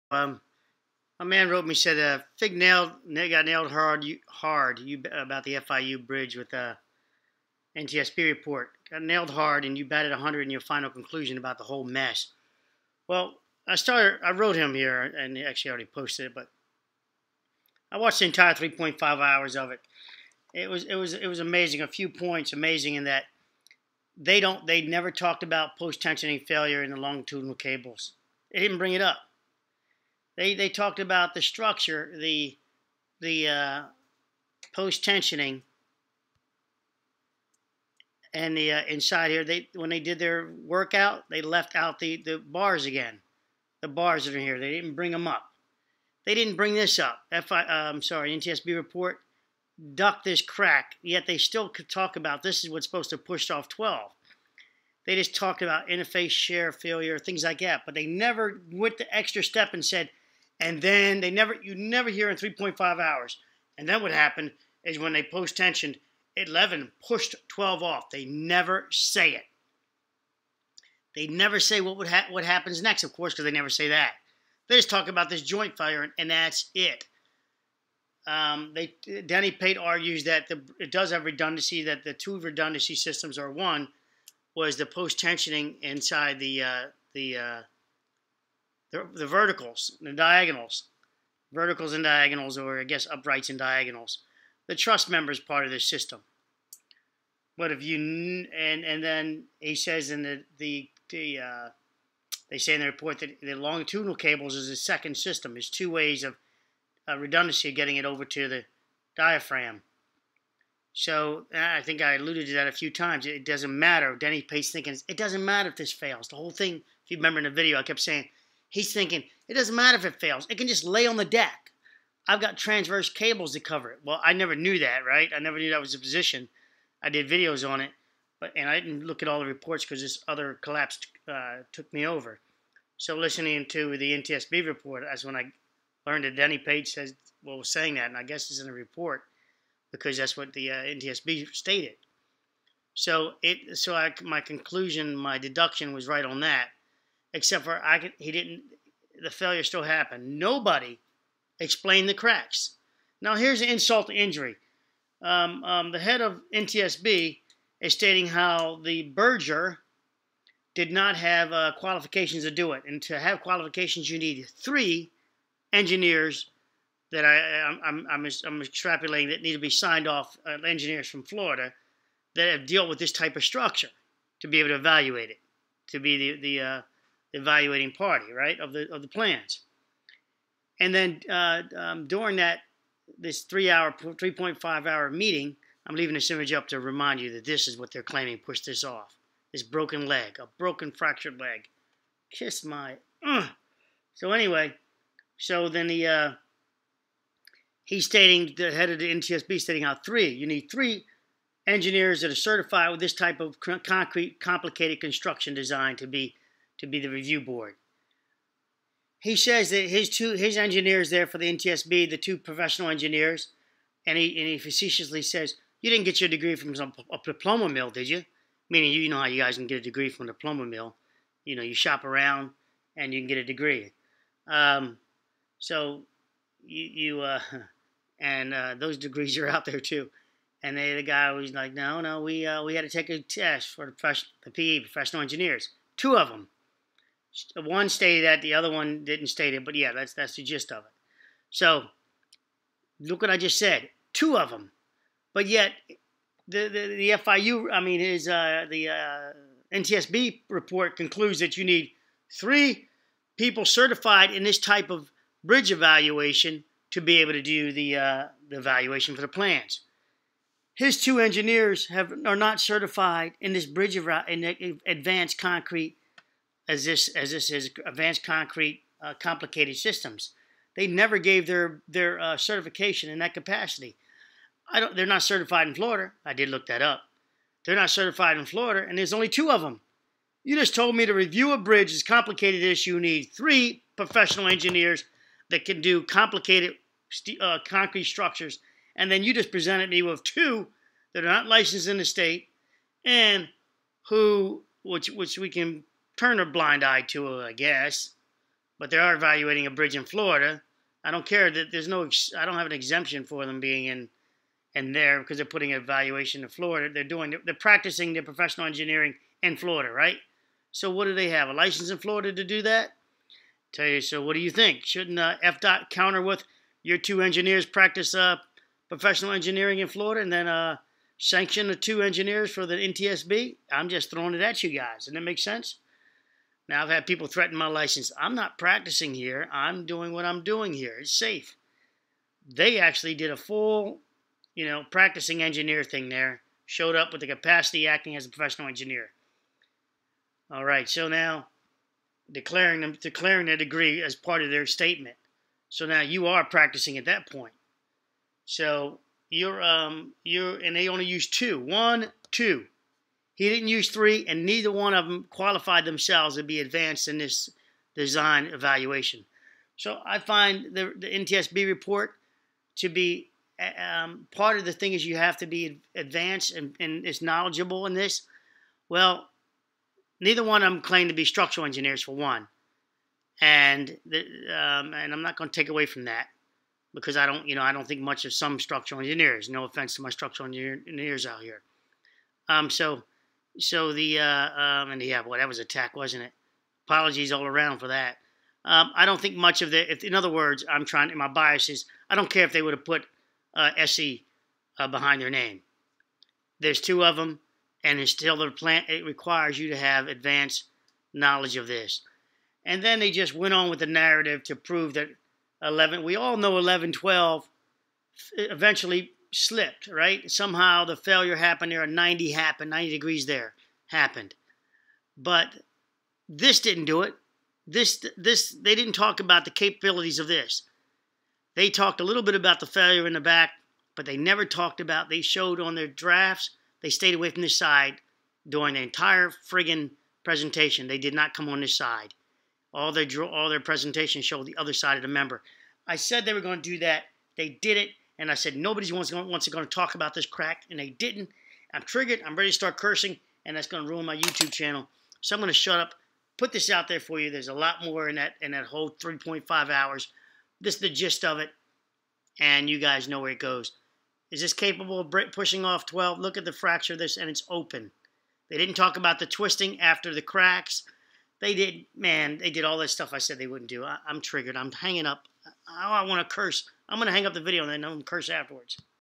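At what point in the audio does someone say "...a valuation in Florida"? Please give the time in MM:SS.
05:05.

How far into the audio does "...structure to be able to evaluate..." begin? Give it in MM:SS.
02:53.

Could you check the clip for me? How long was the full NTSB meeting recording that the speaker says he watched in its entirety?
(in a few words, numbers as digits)
3.5 hours.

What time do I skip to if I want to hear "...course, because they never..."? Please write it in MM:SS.
01:13.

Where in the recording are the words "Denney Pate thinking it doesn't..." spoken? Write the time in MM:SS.
01:54.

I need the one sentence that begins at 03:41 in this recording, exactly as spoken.
You know, you shop around and you can get a degree.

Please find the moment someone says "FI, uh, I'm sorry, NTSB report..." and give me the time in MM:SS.
00:47.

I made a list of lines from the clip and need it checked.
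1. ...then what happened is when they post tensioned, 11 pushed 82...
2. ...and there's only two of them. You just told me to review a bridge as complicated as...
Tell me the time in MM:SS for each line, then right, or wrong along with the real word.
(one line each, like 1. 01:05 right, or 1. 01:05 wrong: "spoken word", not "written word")
1. 01:03 wrong: "12", not "82"
2. 04:38 right.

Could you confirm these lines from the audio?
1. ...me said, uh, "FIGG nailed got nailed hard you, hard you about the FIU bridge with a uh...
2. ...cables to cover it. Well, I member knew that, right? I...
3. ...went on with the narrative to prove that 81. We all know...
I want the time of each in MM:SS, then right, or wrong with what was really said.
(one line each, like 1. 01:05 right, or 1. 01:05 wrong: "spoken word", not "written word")
1. 00:01 right
2. 02:03 wrong: "never", not "member"
3. 06:43 wrong: "11", not "81".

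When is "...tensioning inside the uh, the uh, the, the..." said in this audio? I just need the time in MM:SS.
01:25.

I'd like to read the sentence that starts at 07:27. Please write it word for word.
There's a lot more in that in that whole 3.5 hours.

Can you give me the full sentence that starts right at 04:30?
They never gave their their uh, certification in that capacity.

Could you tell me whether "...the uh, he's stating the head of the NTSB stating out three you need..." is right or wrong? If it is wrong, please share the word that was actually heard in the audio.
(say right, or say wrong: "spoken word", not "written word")
right.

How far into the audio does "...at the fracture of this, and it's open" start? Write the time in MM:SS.
07:36.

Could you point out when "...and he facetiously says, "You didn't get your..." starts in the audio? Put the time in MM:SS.
03:34.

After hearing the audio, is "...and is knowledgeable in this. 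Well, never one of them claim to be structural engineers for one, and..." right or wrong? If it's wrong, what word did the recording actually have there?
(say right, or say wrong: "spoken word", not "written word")
wrong: "neither", not "never".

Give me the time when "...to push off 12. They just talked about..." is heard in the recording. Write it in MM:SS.
00:53.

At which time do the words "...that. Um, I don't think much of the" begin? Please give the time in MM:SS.
06:27.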